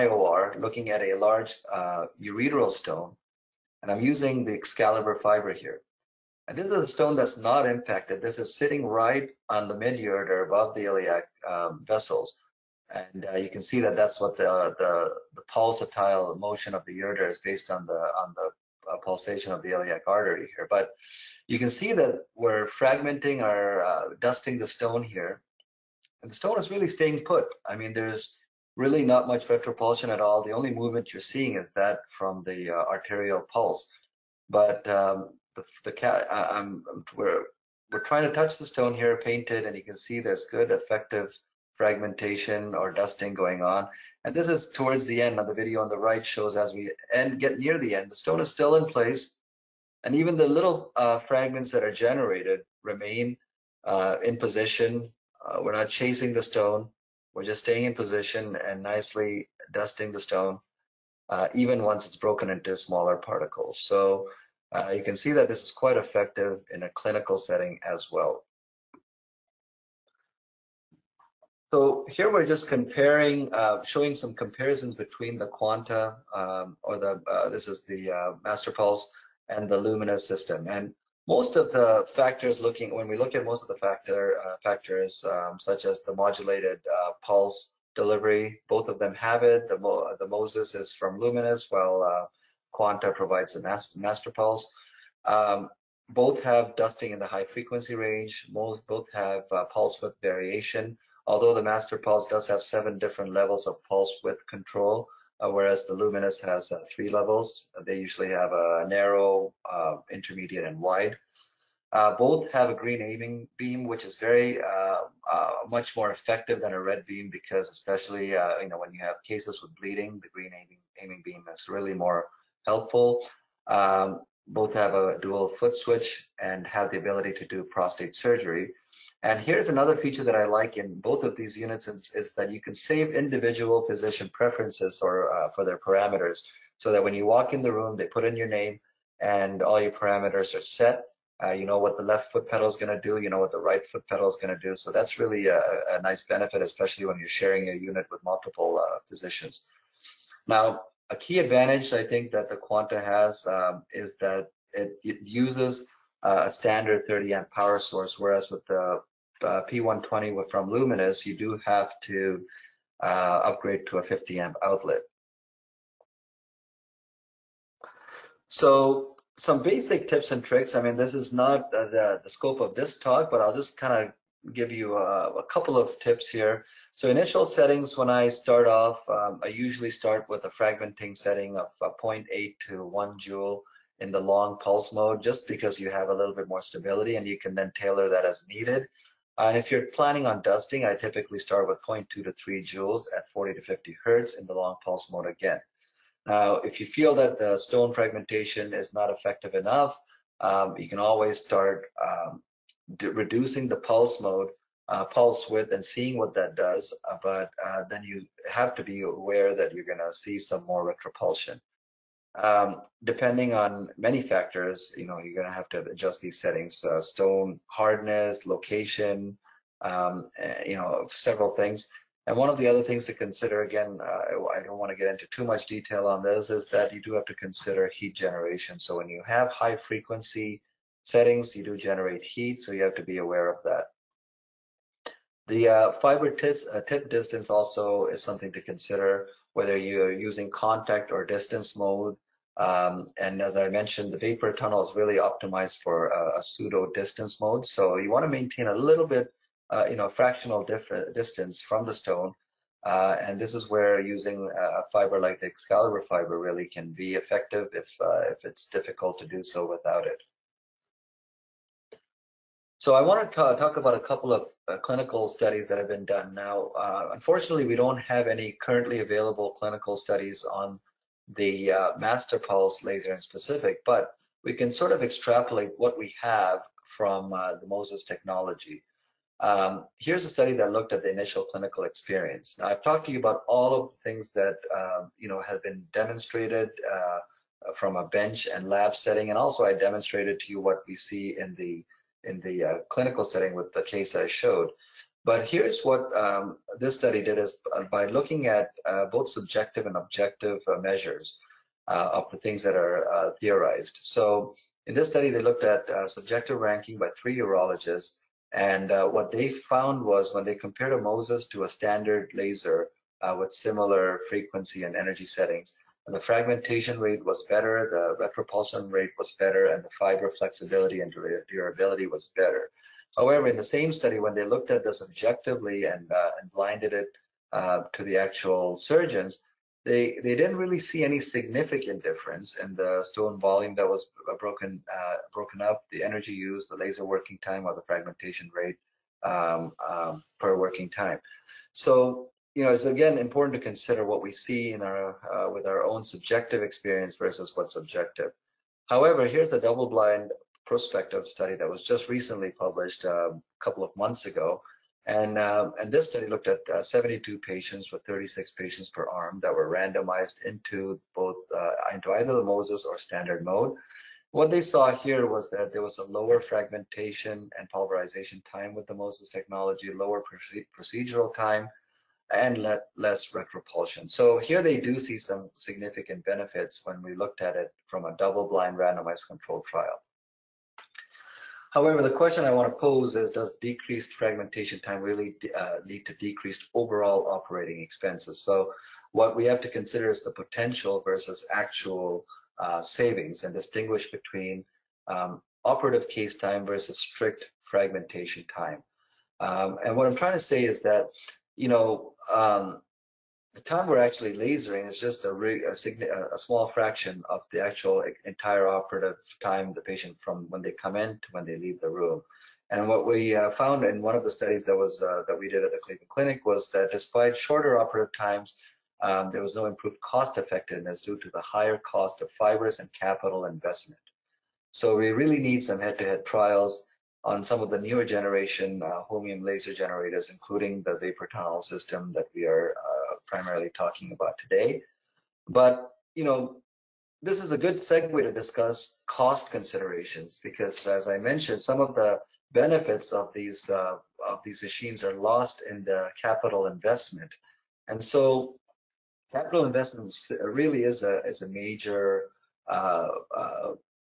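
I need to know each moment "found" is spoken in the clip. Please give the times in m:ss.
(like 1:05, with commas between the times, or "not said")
5:09, 6:53.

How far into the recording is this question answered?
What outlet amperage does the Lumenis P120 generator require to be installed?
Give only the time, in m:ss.
2:44.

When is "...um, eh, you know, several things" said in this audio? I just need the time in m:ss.
3:39.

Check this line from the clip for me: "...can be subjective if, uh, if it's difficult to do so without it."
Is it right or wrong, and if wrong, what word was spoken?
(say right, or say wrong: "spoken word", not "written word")
wrong: "effective", not "subjective".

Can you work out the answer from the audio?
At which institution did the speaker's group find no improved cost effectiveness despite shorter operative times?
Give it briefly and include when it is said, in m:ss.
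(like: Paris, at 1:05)
Cleveland Clinic, at 6:55.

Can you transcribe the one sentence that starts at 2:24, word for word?
So that's really a, a, nice benefit, especially when you're sharing a unit with multiple uh, physicians.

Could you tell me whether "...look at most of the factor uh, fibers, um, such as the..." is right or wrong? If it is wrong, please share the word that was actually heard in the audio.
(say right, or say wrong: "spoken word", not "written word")
wrong: "factors", not "fibers".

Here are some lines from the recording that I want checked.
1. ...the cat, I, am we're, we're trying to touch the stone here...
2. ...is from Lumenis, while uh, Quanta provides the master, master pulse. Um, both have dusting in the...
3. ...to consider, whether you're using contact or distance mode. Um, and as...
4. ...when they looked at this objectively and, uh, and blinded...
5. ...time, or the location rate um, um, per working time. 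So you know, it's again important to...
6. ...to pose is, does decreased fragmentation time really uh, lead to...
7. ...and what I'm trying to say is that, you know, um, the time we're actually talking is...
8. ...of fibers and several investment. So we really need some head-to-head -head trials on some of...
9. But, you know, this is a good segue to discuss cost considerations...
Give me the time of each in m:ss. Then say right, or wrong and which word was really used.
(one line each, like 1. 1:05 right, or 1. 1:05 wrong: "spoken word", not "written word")
1. 0:35 right
2. 1:30 right
3. 3:58 right
4. 5:24 right
5. 5:37 wrong: "fragmentation", not "location"
6. 6:22 right
7. 6:39 wrong: "lasering", not "talking"
8. 7:02 wrong: "capital", not "several"
9. 7:15 right.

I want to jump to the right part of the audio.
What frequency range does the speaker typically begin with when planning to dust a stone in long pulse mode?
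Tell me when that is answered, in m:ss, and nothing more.
3:13.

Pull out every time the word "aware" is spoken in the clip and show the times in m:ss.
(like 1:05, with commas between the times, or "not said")
3:29, 3:53.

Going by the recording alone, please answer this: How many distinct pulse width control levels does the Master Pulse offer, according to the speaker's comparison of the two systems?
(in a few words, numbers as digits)
7.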